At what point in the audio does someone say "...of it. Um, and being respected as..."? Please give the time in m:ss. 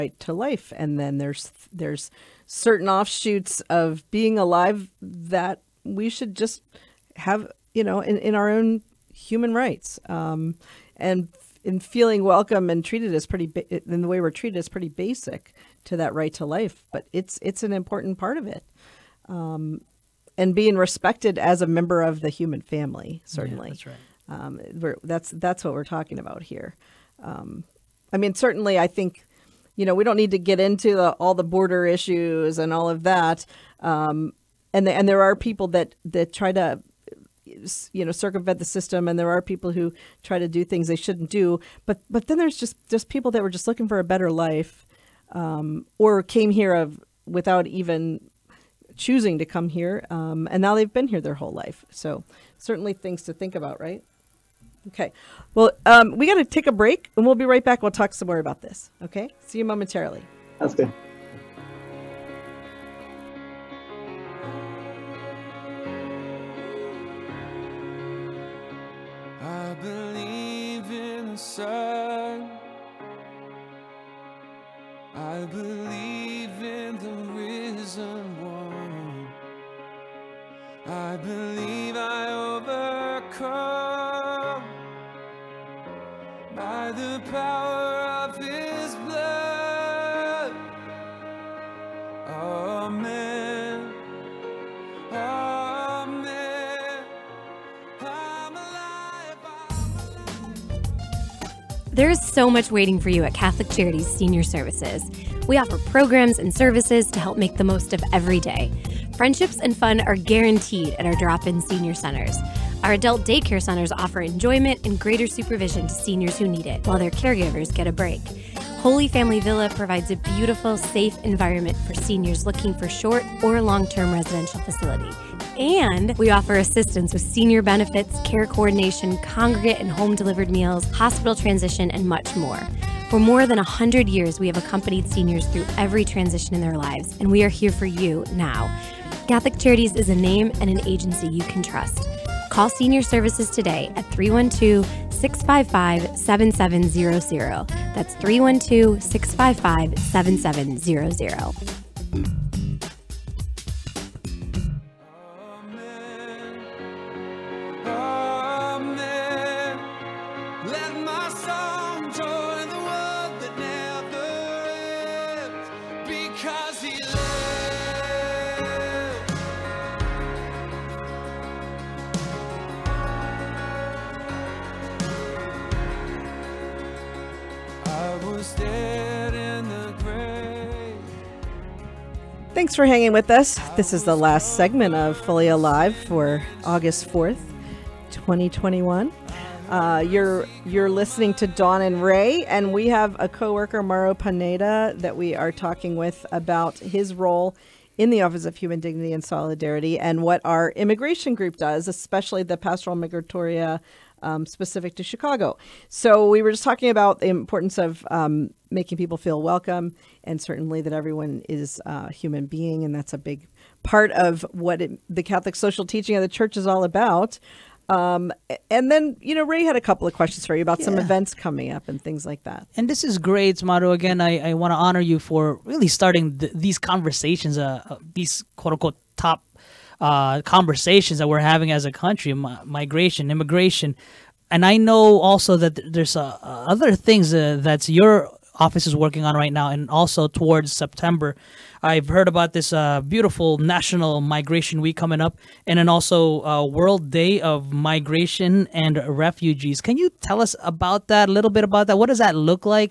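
0:18.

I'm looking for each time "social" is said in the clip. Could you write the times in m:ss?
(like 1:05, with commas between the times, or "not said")
3:35.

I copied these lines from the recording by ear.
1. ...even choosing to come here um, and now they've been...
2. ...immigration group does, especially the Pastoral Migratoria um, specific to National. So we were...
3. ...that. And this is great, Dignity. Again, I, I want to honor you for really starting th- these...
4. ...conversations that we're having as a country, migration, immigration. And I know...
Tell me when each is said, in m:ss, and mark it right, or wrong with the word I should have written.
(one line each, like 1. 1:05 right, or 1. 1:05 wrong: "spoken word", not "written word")
1. 0:47 right
2. 3:20 wrong: "Chicago", not "National"
3. 3:42 wrong: "Mauro", not "Dignity"
4. 3:50 right.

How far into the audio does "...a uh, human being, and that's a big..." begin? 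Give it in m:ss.
3:31.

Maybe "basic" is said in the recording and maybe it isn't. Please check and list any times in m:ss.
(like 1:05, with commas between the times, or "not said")
0:14.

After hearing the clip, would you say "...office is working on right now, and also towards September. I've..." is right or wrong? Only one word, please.
right.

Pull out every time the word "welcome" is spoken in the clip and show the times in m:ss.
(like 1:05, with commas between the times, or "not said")
0:12, 3:29.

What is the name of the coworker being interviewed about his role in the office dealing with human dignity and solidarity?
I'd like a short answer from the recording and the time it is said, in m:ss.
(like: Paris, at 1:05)
Mauro Pineda, at 3:13.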